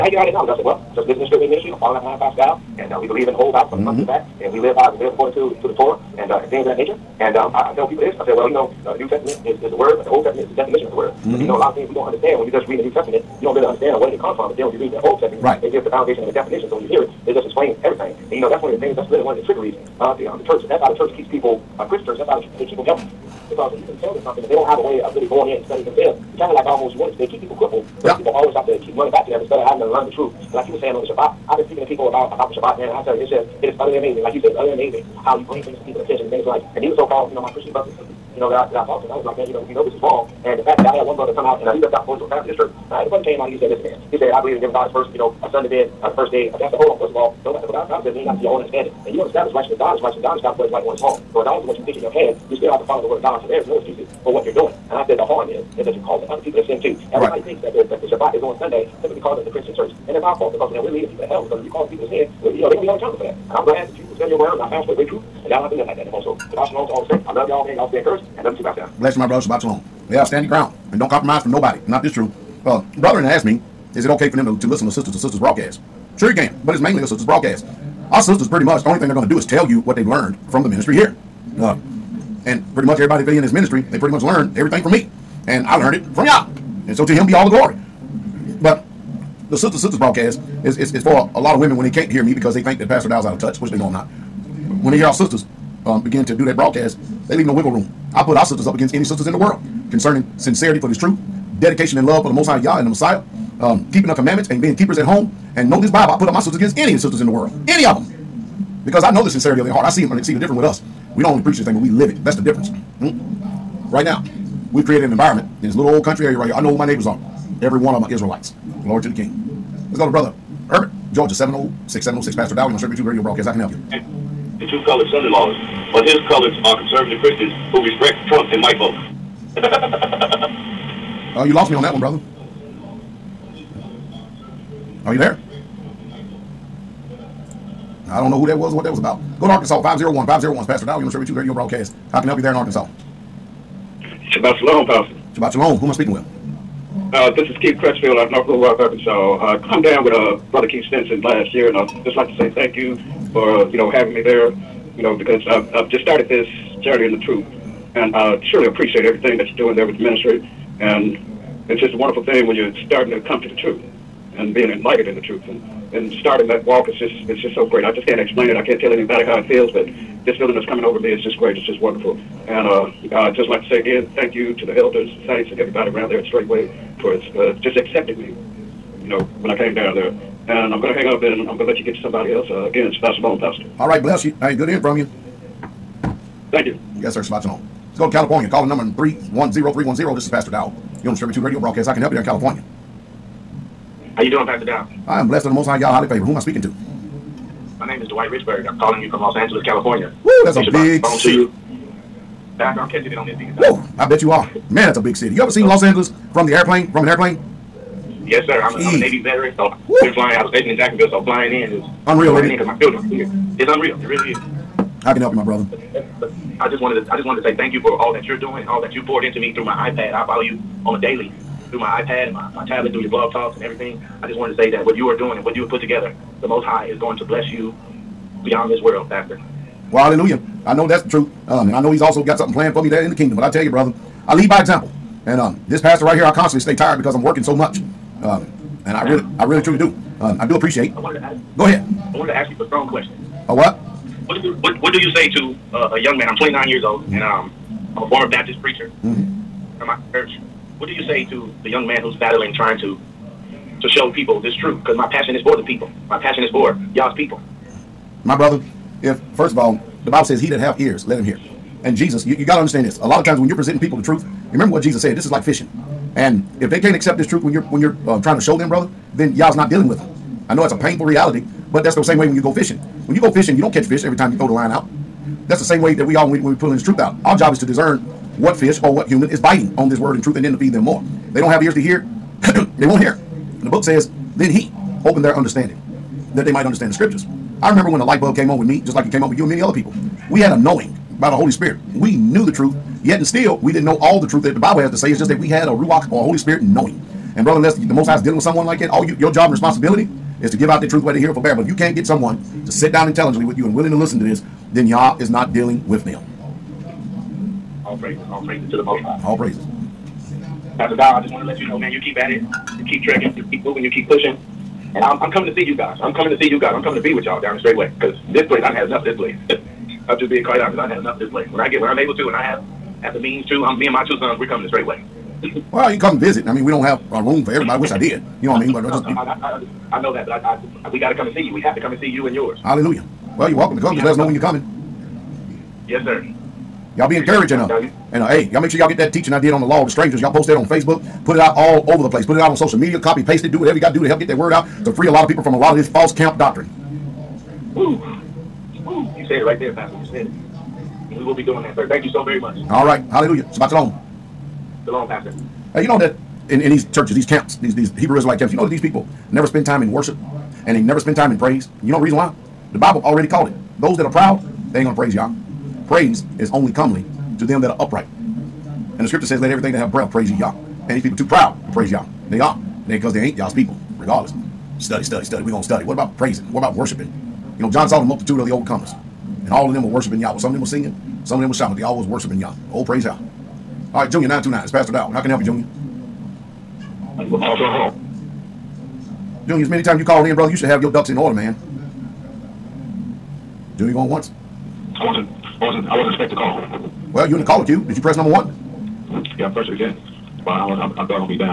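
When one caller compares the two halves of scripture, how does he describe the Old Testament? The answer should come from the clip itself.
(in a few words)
the definition of the word.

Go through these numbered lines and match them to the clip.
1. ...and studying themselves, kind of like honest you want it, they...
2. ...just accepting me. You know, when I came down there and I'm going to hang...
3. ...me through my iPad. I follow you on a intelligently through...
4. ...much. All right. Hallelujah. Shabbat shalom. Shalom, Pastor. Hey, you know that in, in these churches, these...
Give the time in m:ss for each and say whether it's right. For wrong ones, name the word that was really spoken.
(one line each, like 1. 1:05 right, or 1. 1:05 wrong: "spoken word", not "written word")
1. 0:25 wrong: "almost", not "honest"
2. 2:57 right
3. 3:39 wrong: "daily", not "intelligently"
4. 5:52 right.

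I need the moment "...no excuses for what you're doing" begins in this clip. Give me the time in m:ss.
0:53.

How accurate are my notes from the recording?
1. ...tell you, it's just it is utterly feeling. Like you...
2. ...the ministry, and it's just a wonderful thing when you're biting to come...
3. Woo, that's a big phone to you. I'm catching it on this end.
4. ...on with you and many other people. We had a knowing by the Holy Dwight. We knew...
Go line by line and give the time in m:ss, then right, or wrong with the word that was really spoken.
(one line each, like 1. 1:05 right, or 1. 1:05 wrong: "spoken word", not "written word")
1. 0:33 wrong: "amazing", not "feeling"
2. 2:39 wrong: "starting", not "biting"
3. 3:20 right
4. 4:49 wrong: "Spirit", not "Dwight".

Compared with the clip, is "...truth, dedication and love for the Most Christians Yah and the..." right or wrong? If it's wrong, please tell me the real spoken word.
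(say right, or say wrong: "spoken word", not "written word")
wrong: "High", not "Christians".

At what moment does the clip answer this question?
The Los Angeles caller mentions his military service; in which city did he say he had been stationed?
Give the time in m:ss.
3:30.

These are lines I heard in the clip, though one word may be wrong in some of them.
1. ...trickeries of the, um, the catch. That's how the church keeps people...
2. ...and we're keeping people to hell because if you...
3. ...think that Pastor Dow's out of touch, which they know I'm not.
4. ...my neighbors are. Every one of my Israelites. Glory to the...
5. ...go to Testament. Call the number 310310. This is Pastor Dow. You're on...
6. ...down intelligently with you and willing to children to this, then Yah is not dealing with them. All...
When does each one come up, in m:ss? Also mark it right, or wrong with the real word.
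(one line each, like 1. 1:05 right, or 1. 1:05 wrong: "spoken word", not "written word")
1. 0:19 wrong: "church", not "catch"
2. 1:00 wrong: "leading", not "keeping"
3. 1:32 right
4. 1:56 right
5. 3:07 wrong: "California", not "Testament"
6. 5:02 wrong: "listen", not "children".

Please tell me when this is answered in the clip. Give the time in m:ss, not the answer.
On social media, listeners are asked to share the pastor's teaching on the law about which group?
5:39.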